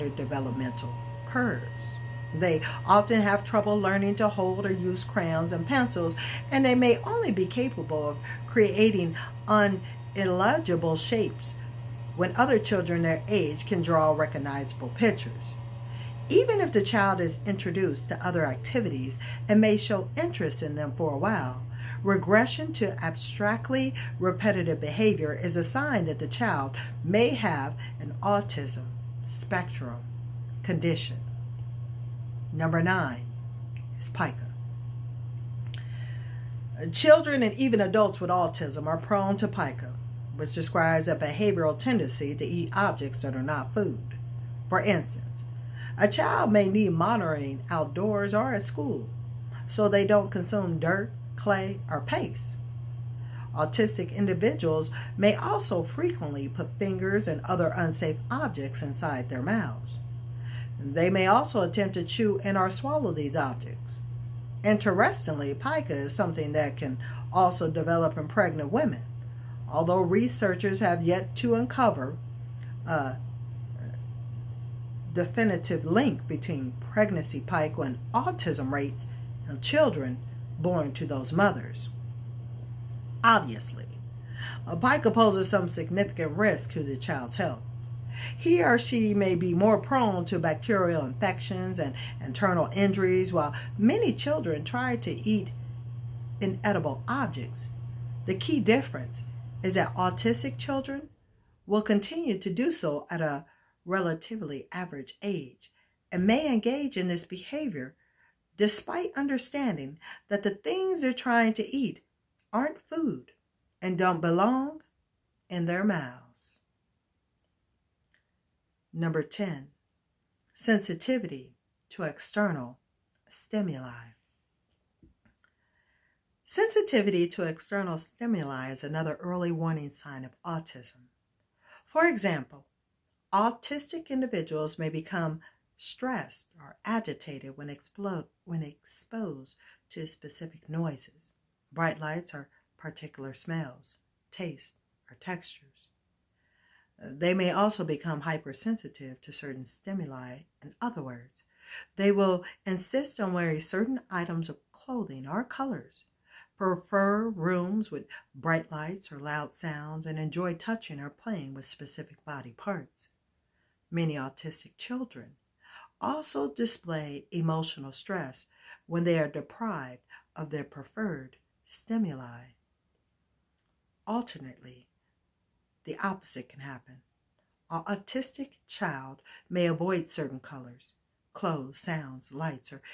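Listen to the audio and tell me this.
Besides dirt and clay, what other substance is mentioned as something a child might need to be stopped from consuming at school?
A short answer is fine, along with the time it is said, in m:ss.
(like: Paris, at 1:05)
paste, at 0:52.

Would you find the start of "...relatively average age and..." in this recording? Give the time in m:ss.
1:43.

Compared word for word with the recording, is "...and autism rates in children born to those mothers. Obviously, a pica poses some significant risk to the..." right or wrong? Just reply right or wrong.
right.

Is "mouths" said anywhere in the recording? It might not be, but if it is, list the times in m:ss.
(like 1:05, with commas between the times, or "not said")
0:59, 1:55.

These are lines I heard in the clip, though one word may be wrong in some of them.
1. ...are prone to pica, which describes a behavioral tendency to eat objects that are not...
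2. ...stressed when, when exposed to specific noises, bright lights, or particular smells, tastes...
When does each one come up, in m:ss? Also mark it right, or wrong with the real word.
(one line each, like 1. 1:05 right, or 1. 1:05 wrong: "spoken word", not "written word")
1. 0:38 right
2. 2:16 wrong: "agitated", not "stressed".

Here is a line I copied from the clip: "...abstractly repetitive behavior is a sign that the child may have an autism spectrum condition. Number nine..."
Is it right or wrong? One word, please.
right.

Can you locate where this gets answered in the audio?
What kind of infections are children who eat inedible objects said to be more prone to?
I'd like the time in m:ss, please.
1:30.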